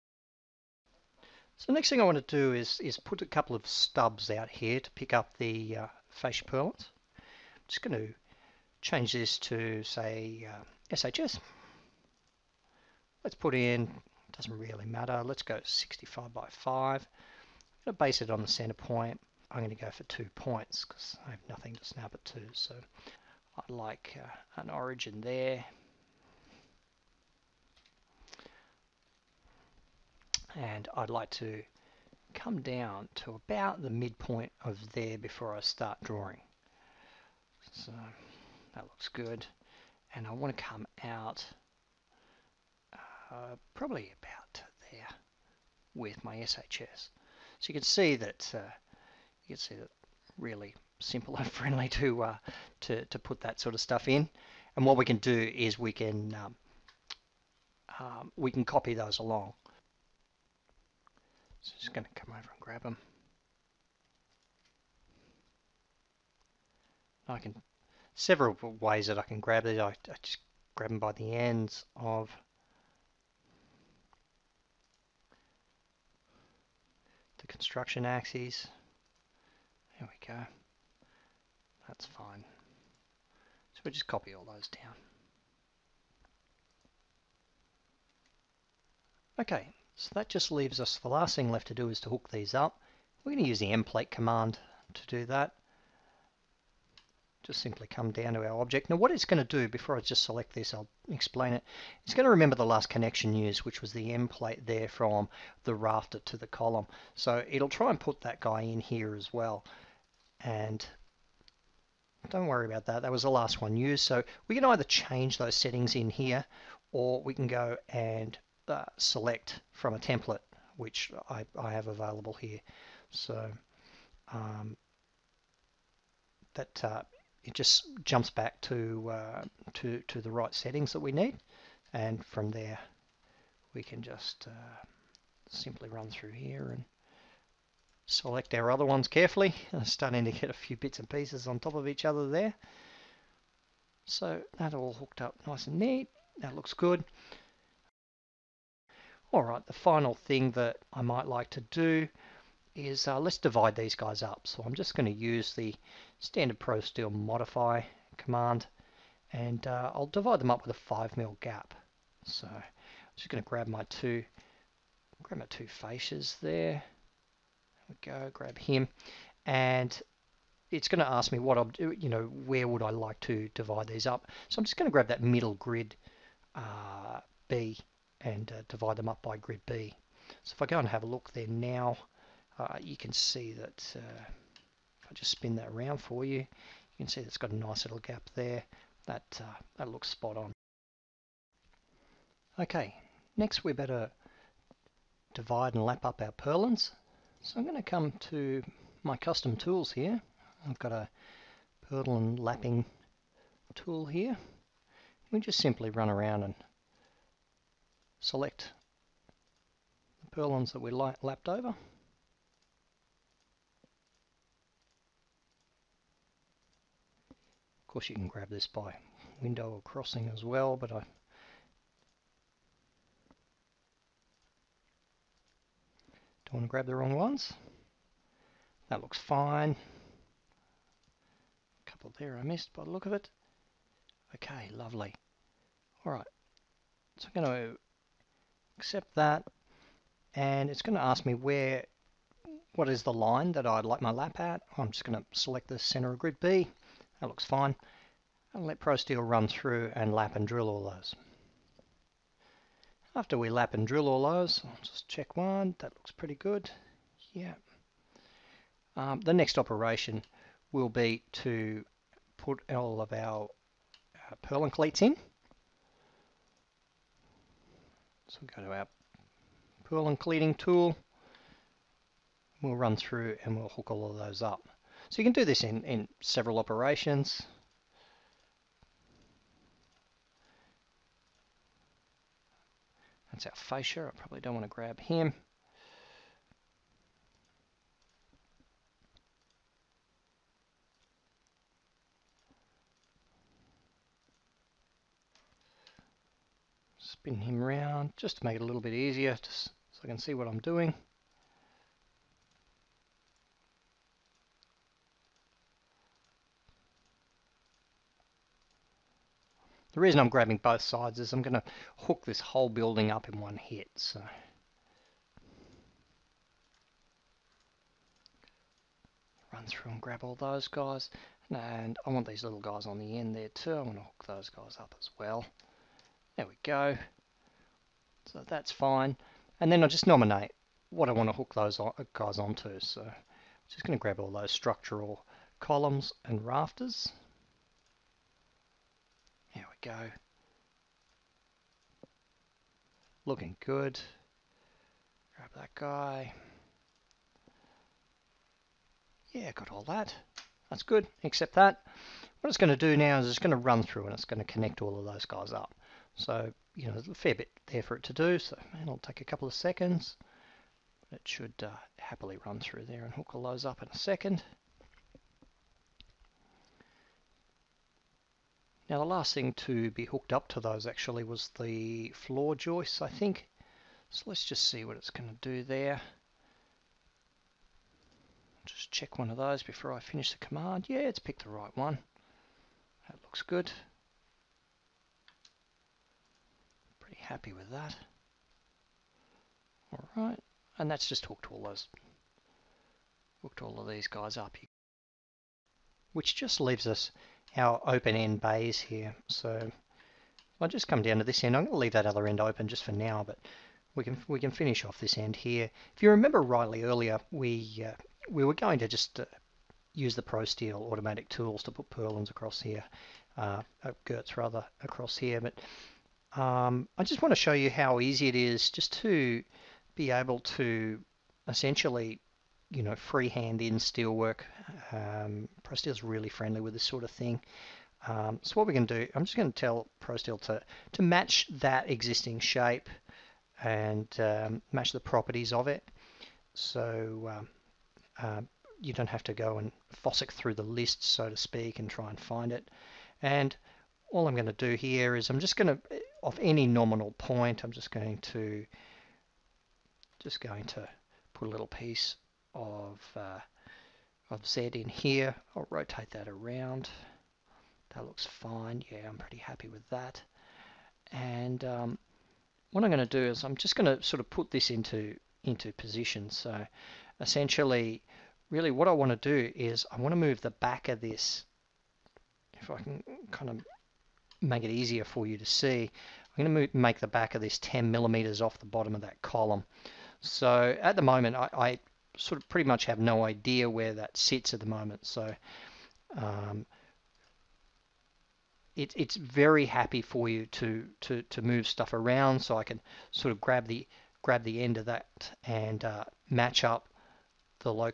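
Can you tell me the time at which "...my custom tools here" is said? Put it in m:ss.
3:19.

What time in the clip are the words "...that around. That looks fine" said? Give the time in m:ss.
7:36.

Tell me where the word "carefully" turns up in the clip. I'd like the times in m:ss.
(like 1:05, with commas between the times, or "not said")
2:19.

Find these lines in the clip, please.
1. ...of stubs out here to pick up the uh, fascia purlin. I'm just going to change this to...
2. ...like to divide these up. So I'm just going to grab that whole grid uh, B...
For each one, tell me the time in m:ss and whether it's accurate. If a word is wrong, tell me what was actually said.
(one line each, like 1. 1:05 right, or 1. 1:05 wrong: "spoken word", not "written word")
1. 0:03 right
2. 2:52 wrong: "middle", not "whole".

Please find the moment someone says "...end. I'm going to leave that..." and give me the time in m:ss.
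6:41.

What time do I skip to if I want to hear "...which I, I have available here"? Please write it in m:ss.
2:00.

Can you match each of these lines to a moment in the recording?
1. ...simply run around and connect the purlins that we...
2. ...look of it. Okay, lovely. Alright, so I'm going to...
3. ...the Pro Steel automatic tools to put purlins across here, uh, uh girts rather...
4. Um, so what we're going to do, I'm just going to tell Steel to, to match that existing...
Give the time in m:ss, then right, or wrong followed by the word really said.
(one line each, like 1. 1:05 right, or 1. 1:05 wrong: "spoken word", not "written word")
1. 3:25 wrong: "select", not "connect"
2. 3:52 right
3. 6:50 right
4. 7:08 wrong: "ProSteel", not "Steel".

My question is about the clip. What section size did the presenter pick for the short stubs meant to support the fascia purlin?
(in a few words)
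65 by 5.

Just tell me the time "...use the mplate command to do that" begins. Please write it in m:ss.
1:33.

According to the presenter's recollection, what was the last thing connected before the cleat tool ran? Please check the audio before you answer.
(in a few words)
floor joists.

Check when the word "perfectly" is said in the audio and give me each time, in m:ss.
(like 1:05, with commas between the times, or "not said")
not said.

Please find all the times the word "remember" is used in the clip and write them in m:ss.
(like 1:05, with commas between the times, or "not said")
1:42, 6:46.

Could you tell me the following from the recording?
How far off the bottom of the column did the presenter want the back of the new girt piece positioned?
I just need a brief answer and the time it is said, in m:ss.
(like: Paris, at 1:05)
10 millimeters, at 7:57.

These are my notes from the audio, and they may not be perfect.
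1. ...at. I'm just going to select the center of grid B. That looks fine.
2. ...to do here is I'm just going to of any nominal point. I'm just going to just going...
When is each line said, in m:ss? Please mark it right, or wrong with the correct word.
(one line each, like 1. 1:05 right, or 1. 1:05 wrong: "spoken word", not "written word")
1. 4:04 right
2. 7:24 right.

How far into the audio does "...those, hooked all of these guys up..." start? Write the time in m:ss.
6:31.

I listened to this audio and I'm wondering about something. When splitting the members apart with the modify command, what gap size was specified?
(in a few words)
5 mil.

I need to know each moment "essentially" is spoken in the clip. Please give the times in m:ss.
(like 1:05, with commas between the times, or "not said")
7:01, 7:47.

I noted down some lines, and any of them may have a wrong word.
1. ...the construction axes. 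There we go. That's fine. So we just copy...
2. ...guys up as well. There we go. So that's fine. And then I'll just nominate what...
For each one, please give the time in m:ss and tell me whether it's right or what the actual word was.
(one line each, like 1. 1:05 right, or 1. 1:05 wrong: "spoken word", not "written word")
1. 1:17 right
2. 5:24 right.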